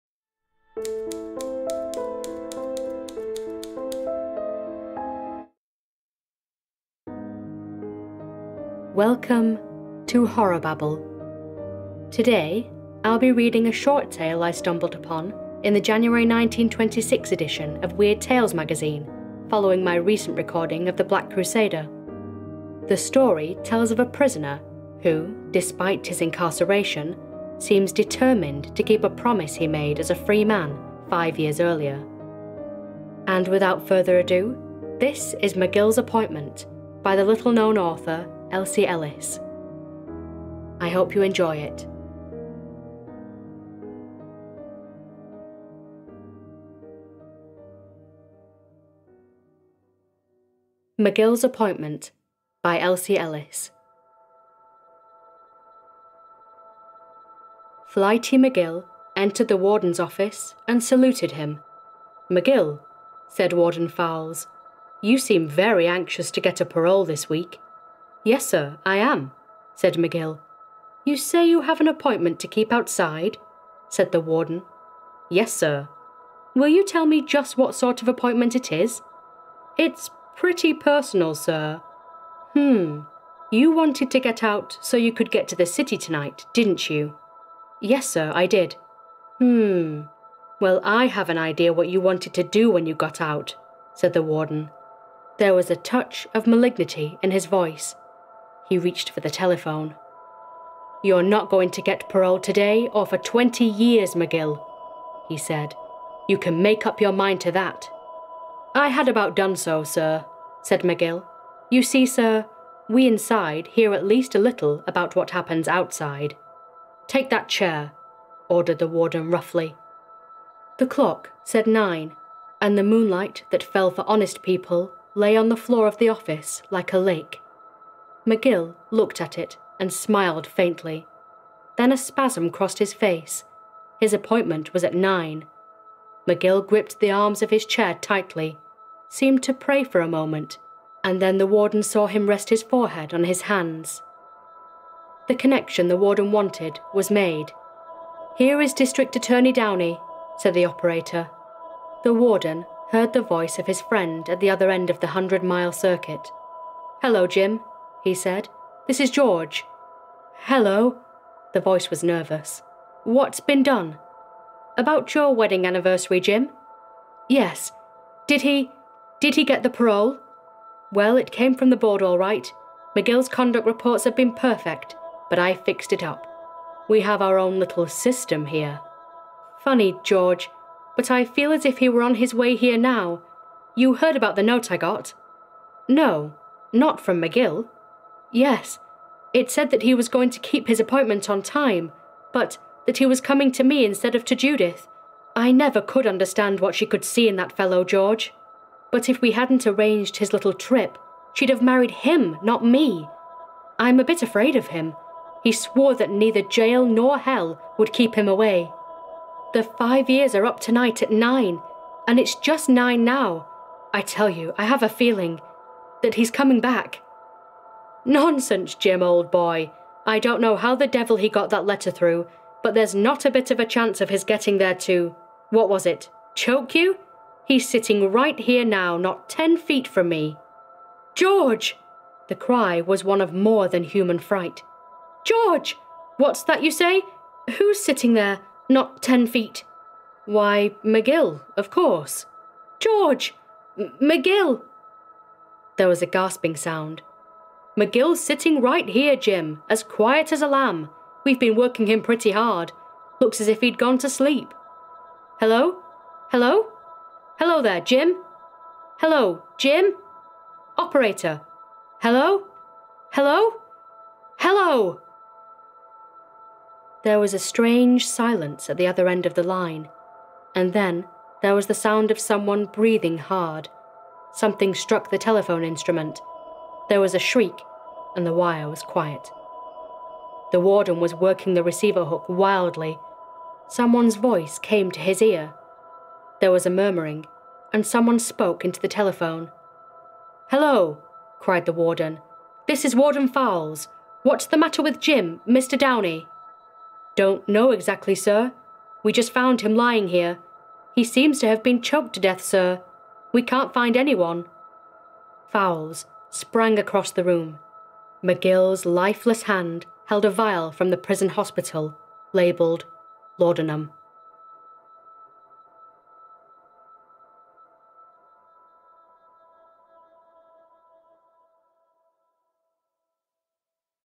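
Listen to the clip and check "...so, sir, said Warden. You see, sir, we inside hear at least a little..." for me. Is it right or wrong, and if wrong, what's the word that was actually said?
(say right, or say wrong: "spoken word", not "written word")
wrong: "McGill", not "Warden".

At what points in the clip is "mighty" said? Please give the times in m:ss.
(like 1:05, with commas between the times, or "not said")
not said.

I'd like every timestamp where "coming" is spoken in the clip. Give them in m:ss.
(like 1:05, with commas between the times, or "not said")
3:13, 3:36.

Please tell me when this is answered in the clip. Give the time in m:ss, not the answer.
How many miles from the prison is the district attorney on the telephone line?
2:35.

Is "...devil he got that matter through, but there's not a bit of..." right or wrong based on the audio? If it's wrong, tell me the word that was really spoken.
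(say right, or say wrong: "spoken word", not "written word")
wrong: "letter", not "matter".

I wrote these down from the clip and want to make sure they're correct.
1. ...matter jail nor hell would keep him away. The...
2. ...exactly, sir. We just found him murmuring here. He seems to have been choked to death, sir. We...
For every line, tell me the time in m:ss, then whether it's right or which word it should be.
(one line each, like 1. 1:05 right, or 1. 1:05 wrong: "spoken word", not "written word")
1. 3:26 wrong: "neither", not "matter"
2. 4:57 wrong: "lying", not "murmuring".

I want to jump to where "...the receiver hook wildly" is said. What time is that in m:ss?
4:41.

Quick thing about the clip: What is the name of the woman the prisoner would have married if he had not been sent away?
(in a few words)
Judith.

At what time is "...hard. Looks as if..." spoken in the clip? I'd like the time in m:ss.
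4:12.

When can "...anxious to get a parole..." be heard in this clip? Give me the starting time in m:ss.
1:05.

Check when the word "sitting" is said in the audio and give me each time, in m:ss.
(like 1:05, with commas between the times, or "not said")
3:47, 3:57, 4:08.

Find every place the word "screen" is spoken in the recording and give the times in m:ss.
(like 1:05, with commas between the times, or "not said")
not said.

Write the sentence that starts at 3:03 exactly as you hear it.
You heard about the note I got?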